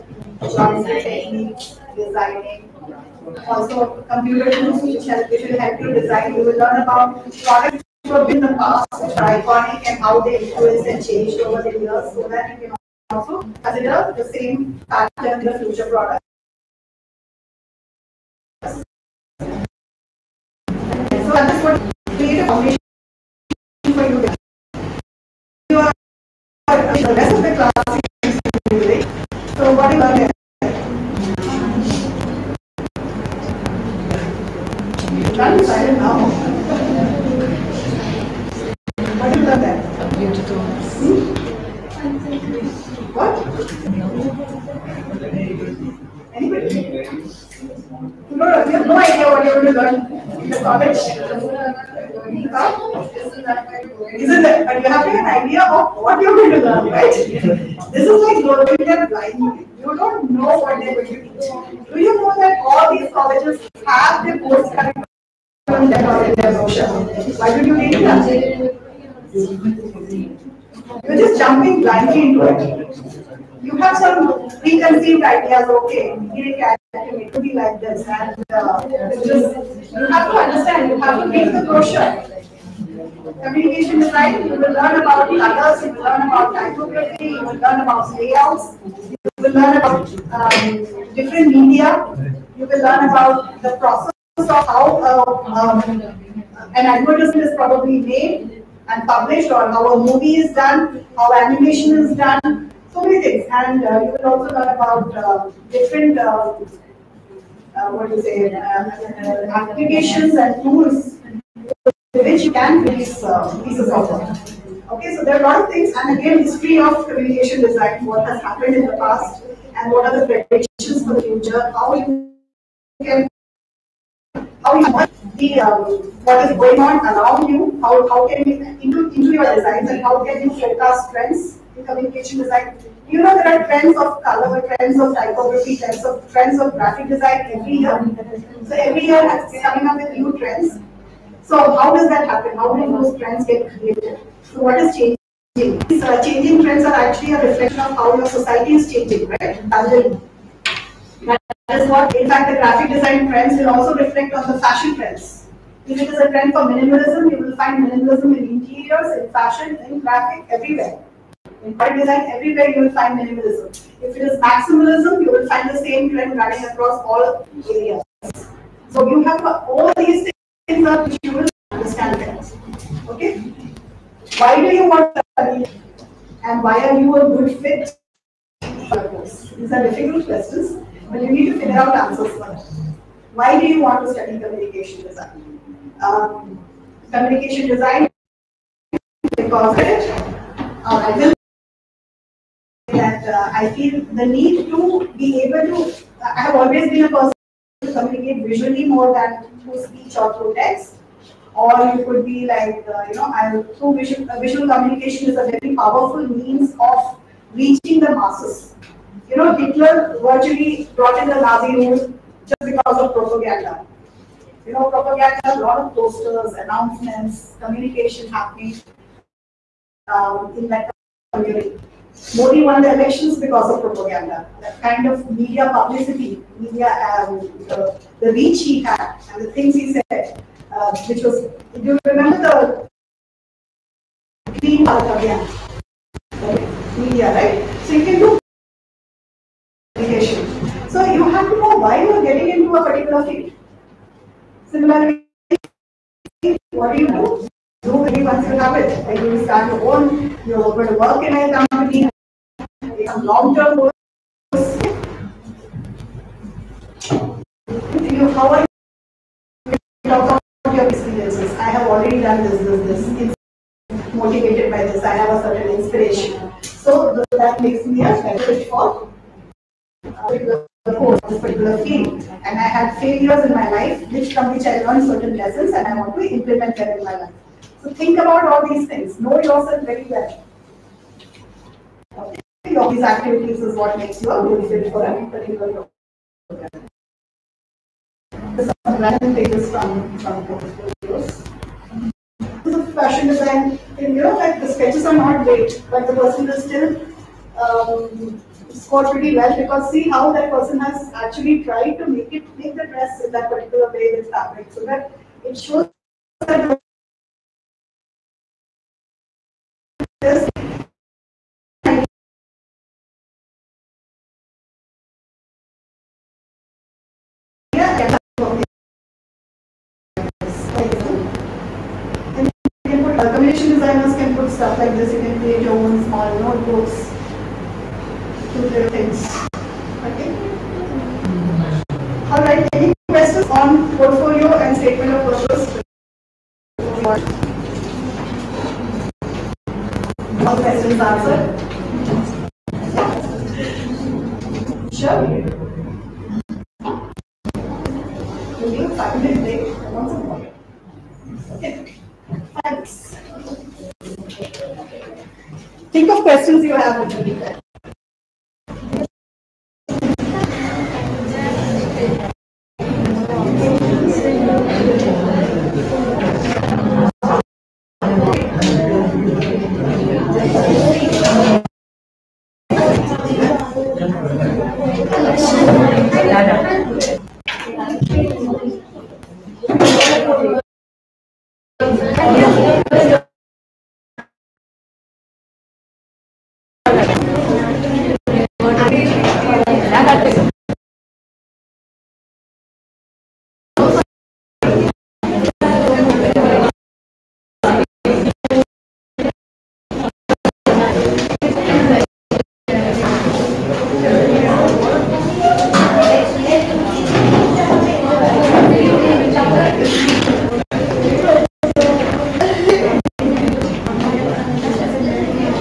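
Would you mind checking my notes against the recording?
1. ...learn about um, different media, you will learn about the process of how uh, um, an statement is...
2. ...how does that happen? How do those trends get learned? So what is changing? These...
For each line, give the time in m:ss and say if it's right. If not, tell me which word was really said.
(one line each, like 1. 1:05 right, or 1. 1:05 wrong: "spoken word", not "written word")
1. 1:29 wrong: "advertisement", not "statement"
2. 2:21 wrong: "created", not "learned".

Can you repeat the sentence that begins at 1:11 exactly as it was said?
You're just jumping blindly into it you have some preconceived ideas, okay, It I can be like this.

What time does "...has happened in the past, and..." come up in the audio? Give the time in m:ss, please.
1:58.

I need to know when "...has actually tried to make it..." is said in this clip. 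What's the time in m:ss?
5:00.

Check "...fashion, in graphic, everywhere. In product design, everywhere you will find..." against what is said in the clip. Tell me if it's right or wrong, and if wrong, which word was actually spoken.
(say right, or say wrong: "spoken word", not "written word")
right.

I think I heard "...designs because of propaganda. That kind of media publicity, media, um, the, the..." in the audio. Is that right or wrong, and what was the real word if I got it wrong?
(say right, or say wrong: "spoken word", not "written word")
wrong: "elections", not "designs".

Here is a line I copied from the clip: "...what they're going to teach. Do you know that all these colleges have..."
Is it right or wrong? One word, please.
right.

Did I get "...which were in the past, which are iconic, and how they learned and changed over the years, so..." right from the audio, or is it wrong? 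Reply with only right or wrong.
wrong.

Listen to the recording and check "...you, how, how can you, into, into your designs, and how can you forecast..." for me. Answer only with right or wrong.
right.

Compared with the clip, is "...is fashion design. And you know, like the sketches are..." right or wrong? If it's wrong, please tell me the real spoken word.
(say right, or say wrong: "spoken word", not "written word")
right.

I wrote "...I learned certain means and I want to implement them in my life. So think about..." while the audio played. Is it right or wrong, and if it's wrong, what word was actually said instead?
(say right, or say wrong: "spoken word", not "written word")
wrong: "lessons", not "means".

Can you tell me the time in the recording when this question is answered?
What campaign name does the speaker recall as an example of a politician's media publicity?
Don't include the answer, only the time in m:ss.
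3:54.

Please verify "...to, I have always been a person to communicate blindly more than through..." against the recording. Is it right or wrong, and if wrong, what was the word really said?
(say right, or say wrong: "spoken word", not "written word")
wrong: "visually", not "blindly".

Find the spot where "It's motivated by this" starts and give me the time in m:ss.
4:23.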